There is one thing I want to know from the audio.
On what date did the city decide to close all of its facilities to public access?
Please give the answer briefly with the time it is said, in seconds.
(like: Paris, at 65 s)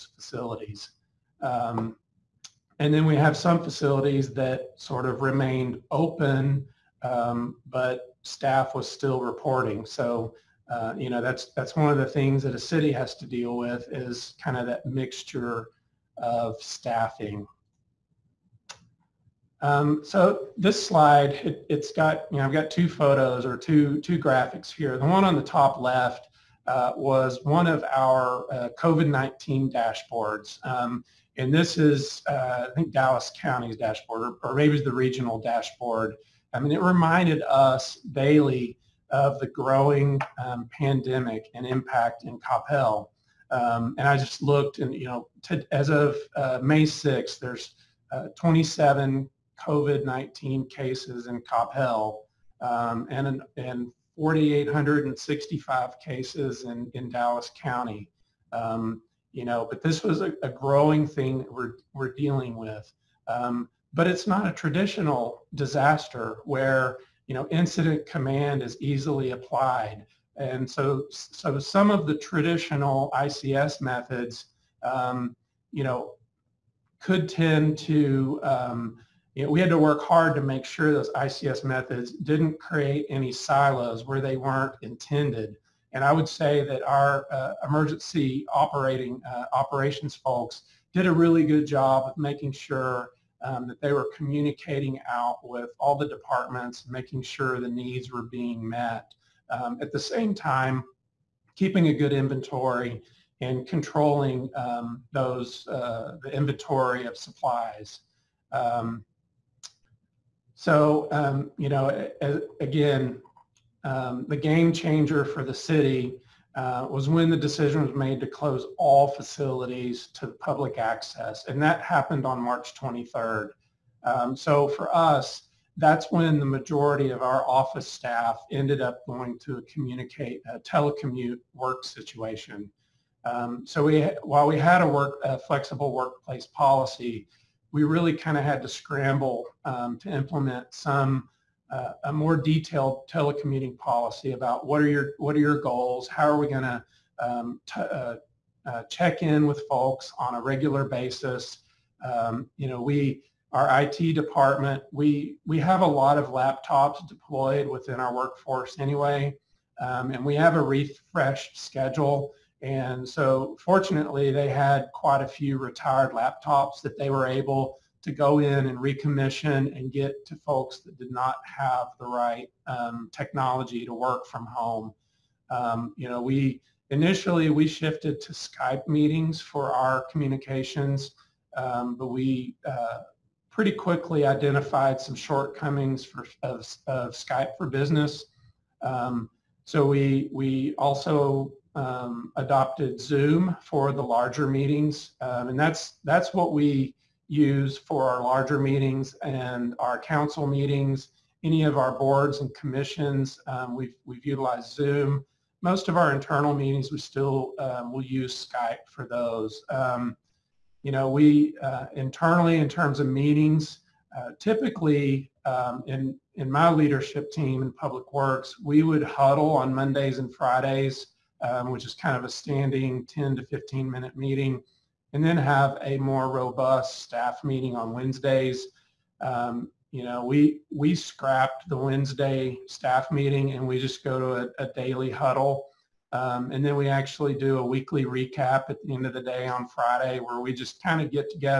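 March 23rd, at 122 s.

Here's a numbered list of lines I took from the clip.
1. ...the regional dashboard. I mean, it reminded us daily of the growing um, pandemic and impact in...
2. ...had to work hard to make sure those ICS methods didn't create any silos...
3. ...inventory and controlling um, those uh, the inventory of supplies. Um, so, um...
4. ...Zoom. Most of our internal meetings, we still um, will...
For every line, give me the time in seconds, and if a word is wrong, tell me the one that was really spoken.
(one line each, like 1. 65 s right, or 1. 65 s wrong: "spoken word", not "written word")
1. 34 s right
2. 79 s right
3. 102 s right
4. 204 s right.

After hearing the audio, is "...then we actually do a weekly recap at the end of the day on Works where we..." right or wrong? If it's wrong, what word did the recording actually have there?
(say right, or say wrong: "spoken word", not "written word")
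wrong: "Friday", not "Works".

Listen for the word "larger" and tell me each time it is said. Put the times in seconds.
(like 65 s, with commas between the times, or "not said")
194 s, 198 s.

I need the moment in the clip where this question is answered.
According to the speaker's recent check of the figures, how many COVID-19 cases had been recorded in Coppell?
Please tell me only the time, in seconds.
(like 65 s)
48 s.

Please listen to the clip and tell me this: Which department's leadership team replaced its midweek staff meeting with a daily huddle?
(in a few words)
Public Works.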